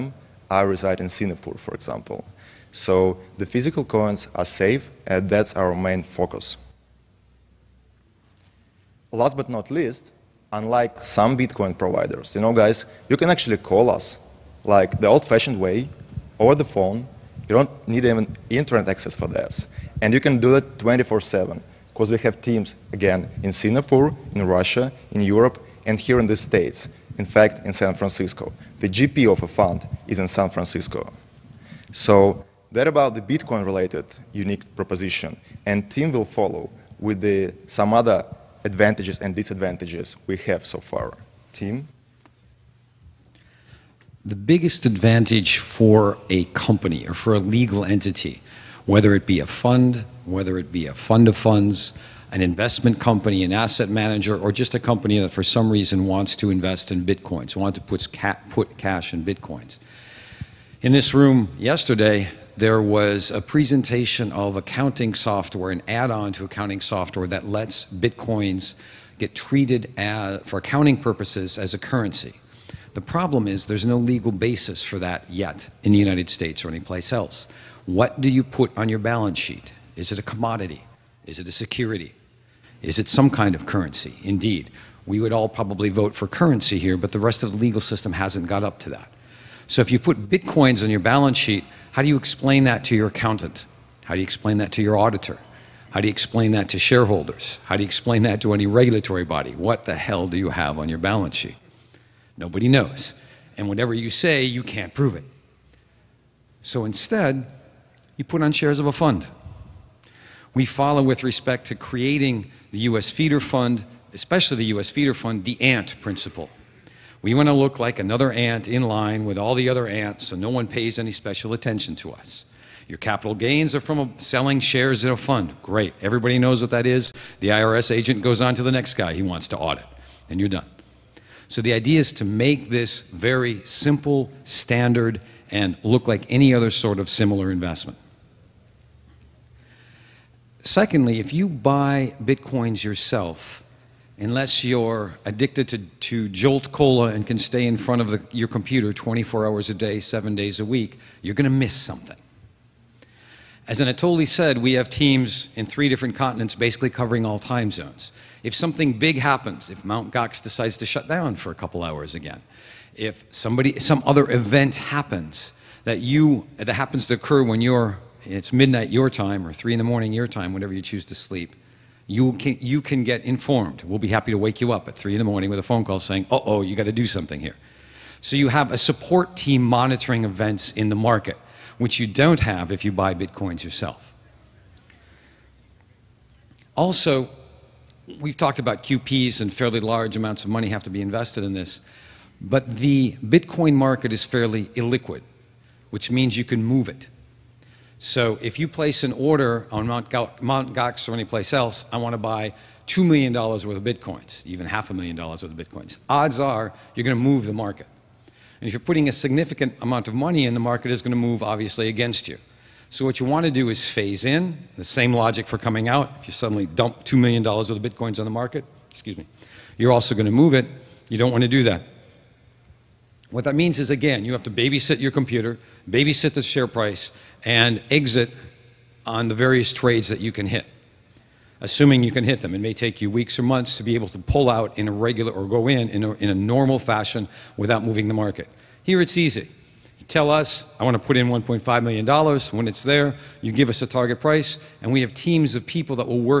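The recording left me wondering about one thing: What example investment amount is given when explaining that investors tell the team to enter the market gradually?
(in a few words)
$1.5 million.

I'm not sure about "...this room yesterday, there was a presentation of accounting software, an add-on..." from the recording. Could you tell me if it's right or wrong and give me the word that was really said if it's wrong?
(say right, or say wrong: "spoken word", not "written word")
right.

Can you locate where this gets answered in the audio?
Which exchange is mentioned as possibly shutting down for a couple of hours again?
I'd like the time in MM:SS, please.
02:39.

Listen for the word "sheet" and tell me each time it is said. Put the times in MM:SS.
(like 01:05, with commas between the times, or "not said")
01:19, 01:31, 01:41.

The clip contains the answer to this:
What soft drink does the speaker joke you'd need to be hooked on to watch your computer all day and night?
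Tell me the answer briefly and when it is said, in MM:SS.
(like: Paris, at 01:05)
Jolt Cola, at 02:26.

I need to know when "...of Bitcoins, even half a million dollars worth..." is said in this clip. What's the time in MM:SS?
03:23.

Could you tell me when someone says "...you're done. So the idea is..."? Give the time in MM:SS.
02:10.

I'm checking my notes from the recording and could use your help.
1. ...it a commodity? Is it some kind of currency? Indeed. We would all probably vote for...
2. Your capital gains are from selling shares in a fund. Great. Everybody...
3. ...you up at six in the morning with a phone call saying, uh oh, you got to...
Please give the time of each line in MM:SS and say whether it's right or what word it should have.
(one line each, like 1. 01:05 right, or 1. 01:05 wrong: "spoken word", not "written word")
1. 01:21 wrong: "security", not "commodity"
2. 02:02 right
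3. 02:54 wrong: "three", not "six".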